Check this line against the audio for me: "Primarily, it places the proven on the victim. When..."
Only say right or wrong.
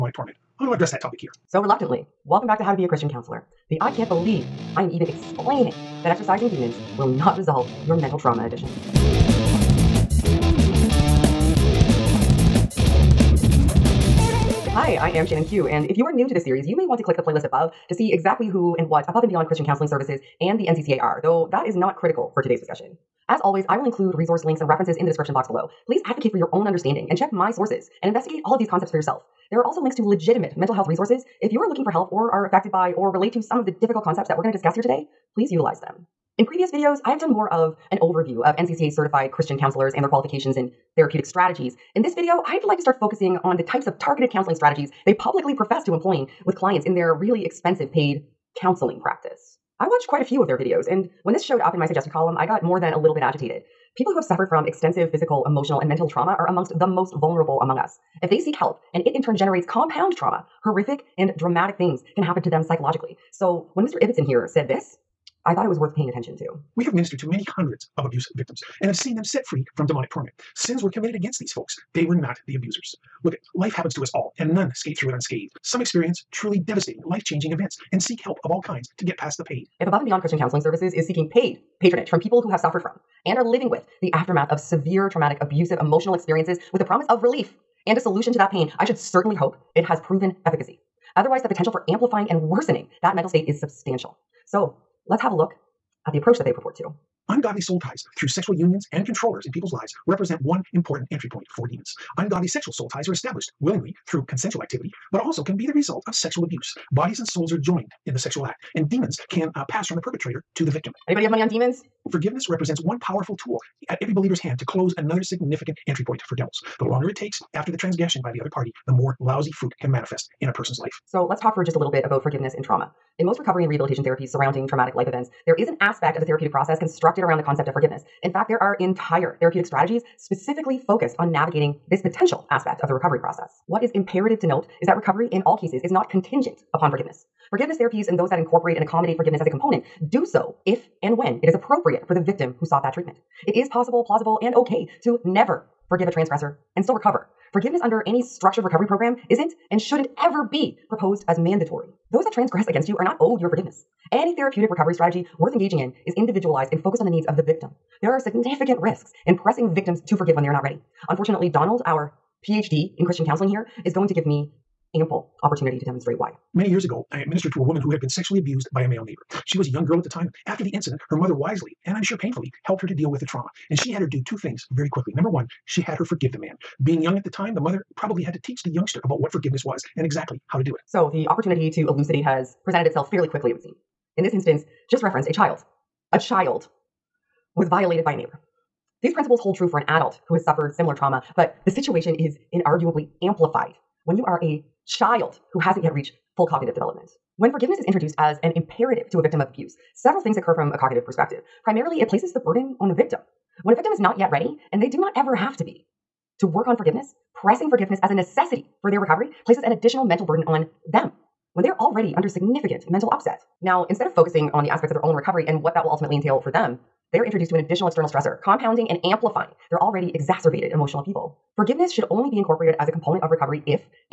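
wrong.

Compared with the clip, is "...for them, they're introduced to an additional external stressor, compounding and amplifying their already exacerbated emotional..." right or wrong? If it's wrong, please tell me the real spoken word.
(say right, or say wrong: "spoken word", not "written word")
right.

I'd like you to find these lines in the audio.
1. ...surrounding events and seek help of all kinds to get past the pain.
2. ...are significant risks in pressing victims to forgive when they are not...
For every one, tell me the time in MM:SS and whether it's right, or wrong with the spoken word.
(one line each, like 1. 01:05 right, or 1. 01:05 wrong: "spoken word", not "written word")
1. 01:17 wrong: "changing", not "surrounding"
2. 02:38 right.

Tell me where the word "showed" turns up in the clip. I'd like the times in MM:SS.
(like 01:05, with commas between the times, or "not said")
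00:51.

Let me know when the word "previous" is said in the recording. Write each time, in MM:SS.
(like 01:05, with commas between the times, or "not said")
00:36.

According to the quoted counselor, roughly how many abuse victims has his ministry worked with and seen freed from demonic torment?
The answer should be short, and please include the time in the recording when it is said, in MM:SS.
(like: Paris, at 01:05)
many hundreds, at 01:07.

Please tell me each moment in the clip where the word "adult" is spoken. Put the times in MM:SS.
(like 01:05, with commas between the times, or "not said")
03:09.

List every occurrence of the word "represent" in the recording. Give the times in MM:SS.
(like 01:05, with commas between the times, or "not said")
01:40, 01:52.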